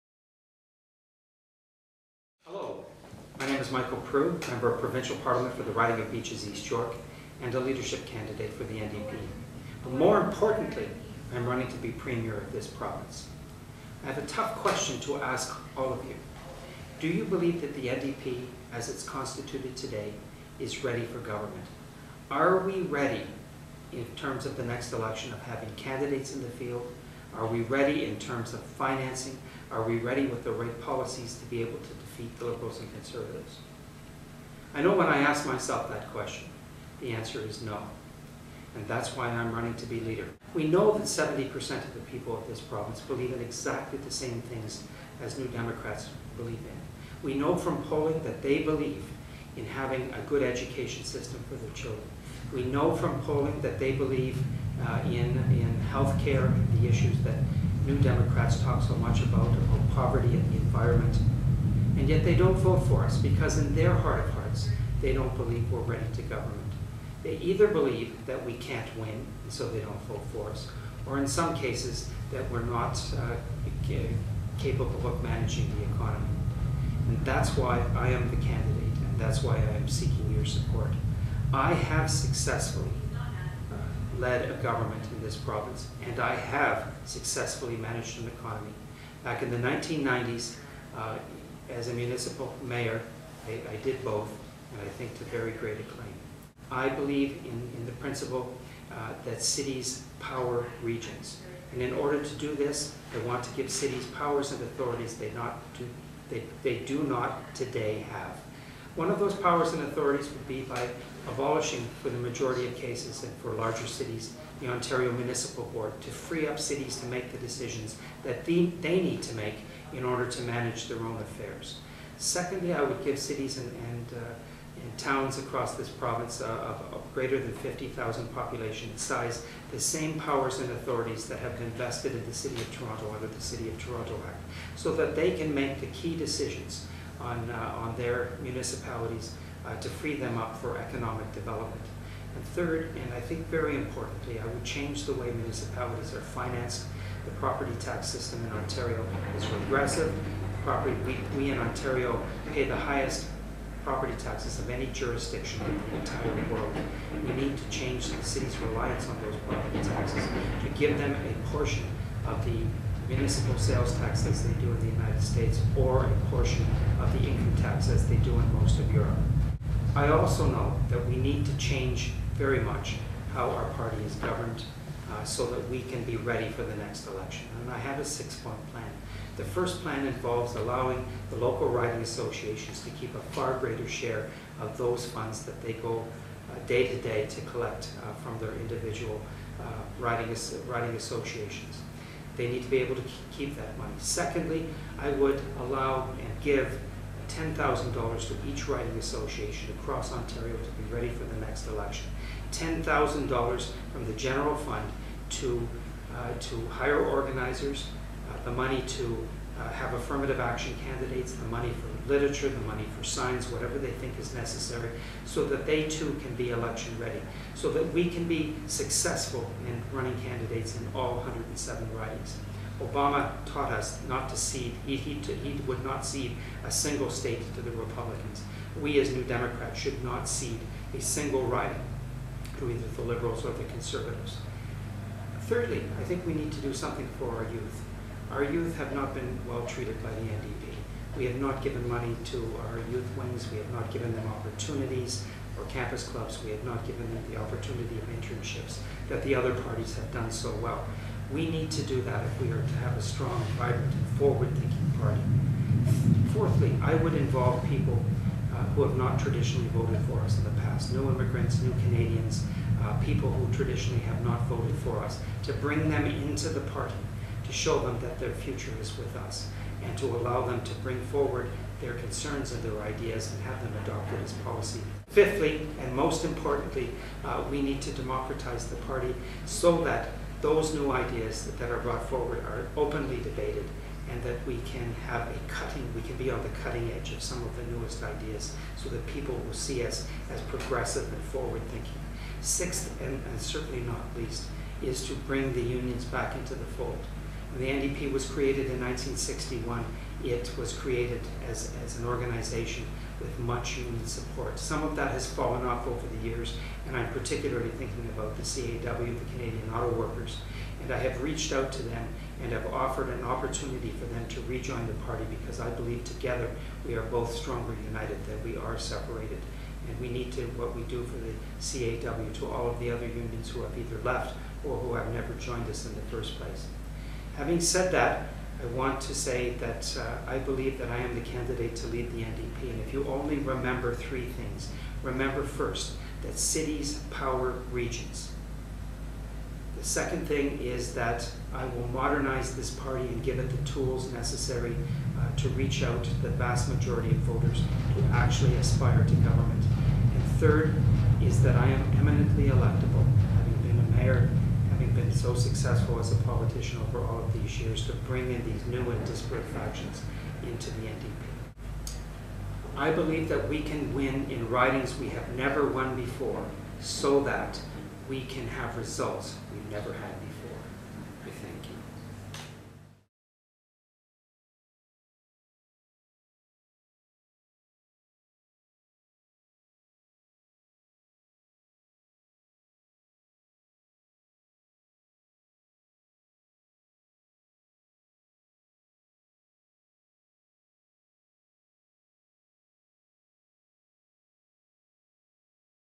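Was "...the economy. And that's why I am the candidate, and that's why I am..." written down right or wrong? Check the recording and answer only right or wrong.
right.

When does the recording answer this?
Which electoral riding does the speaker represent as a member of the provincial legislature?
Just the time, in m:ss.
0:06.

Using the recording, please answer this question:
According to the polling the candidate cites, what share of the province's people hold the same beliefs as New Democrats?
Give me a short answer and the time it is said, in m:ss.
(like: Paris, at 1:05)
70%, at 0:41.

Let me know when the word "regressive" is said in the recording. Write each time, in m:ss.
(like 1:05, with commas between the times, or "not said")
2:29.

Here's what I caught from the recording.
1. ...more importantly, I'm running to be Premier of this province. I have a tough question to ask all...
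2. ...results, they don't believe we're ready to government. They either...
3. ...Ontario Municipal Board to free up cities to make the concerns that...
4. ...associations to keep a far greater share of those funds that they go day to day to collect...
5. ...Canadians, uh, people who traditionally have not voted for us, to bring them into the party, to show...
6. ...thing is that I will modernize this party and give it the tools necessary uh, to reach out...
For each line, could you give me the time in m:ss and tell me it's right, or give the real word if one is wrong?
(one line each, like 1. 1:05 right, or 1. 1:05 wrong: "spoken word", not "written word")
1. 0:09 right
2. 1:04 wrong: "hearts", not "results"
3. 1:54 wrong: "decisions", not "concerns"
4. 3:02 right
5. 4:21 right
6. 5:40 right.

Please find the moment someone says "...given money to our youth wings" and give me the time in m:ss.
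4:01.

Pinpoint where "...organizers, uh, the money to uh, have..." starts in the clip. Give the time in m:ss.
3:27.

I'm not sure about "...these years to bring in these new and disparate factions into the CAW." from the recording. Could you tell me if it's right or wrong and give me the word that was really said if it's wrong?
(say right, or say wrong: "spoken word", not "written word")
wrong: "NDP", not "CAW".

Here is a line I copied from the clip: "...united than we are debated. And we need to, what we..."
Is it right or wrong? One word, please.
wrong.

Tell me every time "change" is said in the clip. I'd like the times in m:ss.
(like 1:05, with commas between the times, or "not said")
2:24, 2:37, 2:51.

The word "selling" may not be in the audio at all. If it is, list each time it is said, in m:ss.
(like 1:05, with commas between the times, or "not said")
not said.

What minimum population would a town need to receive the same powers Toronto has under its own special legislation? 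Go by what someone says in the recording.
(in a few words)
50,000.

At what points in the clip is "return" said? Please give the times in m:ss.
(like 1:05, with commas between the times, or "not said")
not said.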